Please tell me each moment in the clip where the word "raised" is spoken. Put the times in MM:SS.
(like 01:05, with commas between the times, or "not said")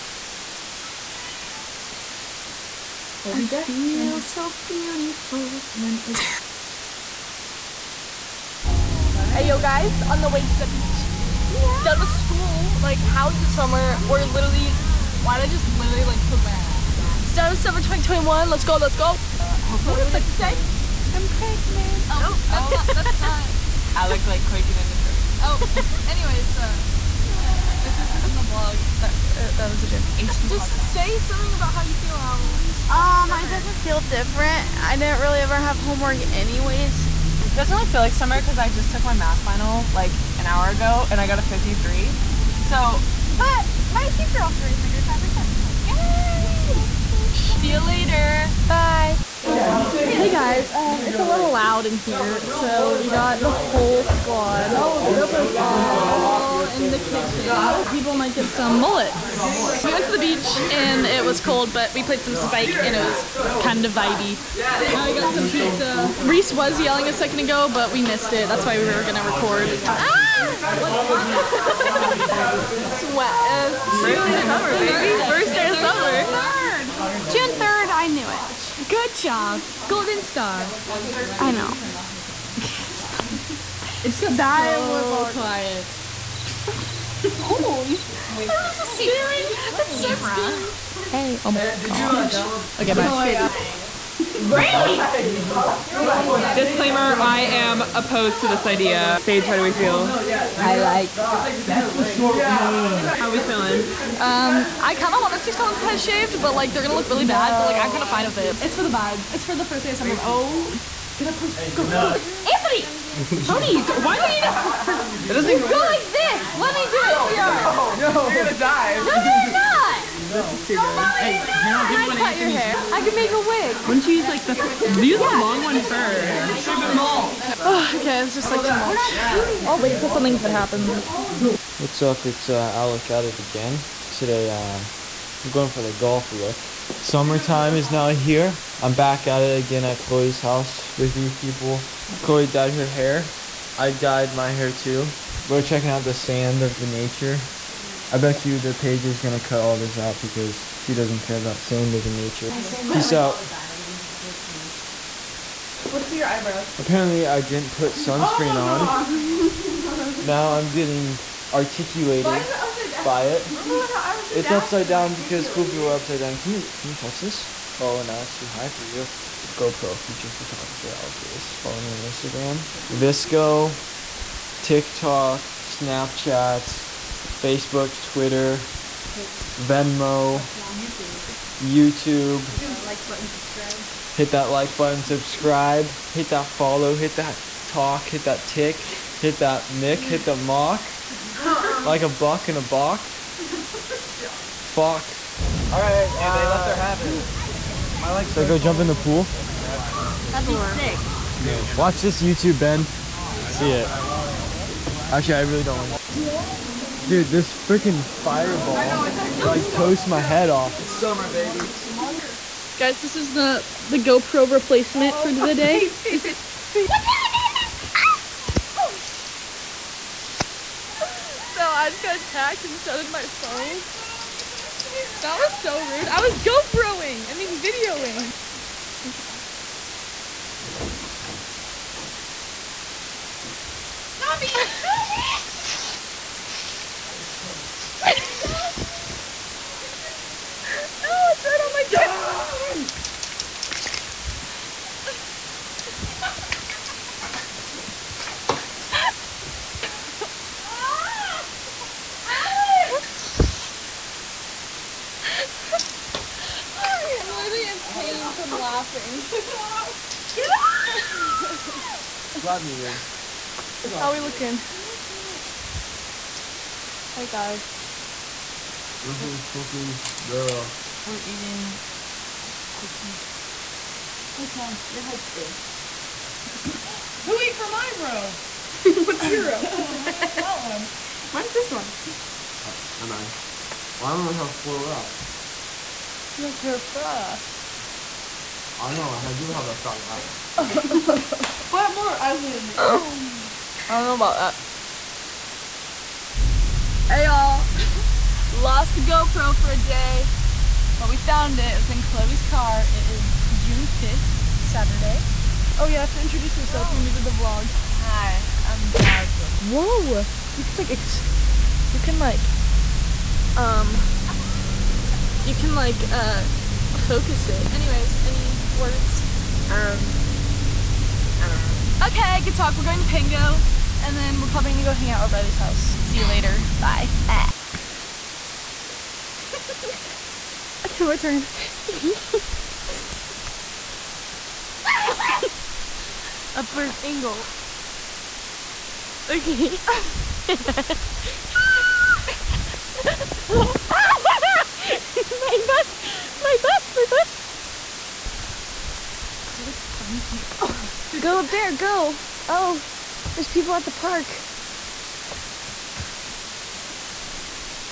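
00:44.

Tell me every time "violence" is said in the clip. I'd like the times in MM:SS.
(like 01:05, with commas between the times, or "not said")
not said.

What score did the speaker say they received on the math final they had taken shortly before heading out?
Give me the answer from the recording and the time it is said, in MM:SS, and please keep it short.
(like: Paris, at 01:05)
53, at 00:41.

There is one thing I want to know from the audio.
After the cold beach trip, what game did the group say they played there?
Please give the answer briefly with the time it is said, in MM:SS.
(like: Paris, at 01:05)
Spike, at 01:02.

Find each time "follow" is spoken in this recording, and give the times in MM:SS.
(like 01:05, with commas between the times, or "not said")
02:51, 03:06.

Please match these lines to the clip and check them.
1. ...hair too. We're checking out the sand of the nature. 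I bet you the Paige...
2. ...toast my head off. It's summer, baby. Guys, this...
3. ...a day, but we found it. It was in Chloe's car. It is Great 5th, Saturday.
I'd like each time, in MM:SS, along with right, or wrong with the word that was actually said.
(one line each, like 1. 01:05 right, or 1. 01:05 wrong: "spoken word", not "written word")
1. 02:24 right
2. 03:29 right
3. 04:59 wrong: "June", not "Great".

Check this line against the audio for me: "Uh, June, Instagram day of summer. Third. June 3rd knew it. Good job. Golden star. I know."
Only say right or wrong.
wrong.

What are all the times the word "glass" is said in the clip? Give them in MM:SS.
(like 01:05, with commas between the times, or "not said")
not said.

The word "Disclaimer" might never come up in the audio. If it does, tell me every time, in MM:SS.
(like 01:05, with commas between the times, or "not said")
01:36.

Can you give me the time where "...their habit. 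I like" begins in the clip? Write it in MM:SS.
03:16.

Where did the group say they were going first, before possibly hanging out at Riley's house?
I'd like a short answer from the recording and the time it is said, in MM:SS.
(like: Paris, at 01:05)
Pango, at 05:23.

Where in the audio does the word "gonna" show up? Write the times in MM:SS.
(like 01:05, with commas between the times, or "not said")
01:09, 01:46, 01:58, 02:29, 05:24.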